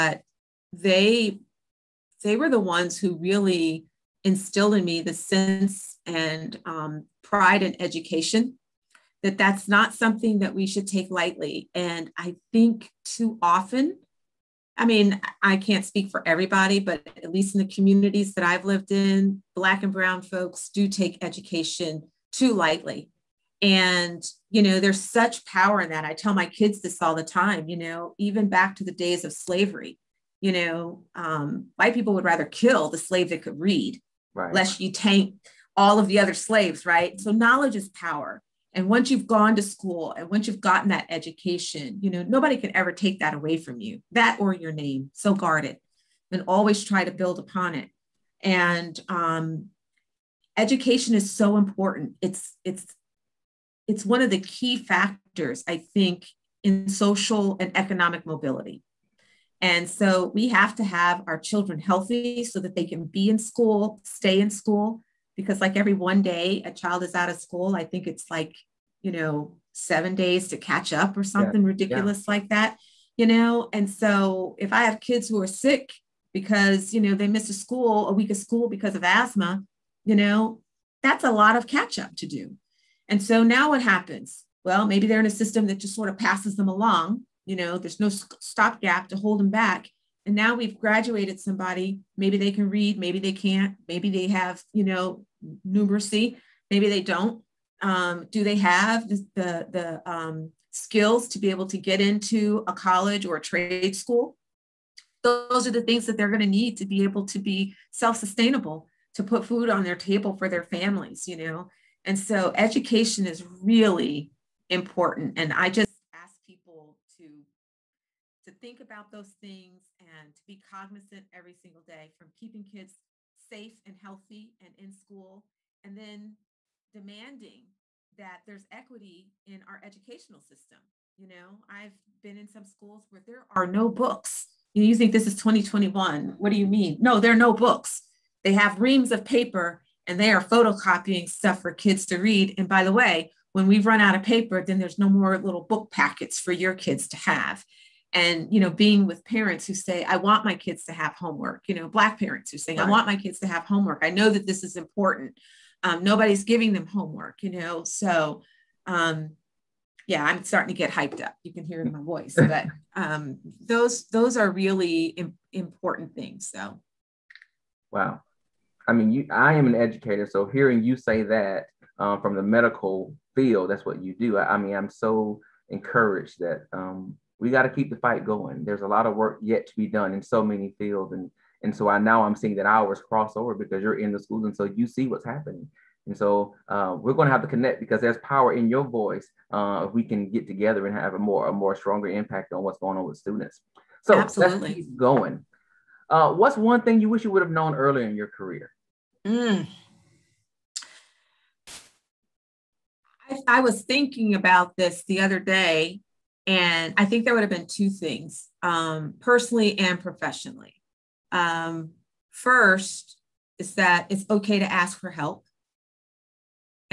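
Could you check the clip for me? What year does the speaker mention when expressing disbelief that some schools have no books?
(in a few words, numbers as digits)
2021.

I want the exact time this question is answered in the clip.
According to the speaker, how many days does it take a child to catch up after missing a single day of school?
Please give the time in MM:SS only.
01:09.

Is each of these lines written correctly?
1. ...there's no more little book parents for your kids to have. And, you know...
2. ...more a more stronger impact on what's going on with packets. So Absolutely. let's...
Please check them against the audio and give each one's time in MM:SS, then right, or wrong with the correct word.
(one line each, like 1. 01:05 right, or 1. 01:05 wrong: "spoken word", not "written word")
1. 02:24 wrong: "packets", not "parents"
2. 03:11 wrong: "students", not "packets".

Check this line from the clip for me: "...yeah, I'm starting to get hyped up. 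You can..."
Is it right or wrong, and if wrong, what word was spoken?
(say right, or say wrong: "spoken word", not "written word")
right.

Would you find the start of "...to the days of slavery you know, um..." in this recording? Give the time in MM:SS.
00:28.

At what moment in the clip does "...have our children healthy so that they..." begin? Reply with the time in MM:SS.
01:00.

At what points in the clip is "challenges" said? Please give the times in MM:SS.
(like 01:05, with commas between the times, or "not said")
not said.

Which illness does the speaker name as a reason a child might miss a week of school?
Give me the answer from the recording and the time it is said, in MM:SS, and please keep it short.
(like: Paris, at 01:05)
asthma, at 01:19.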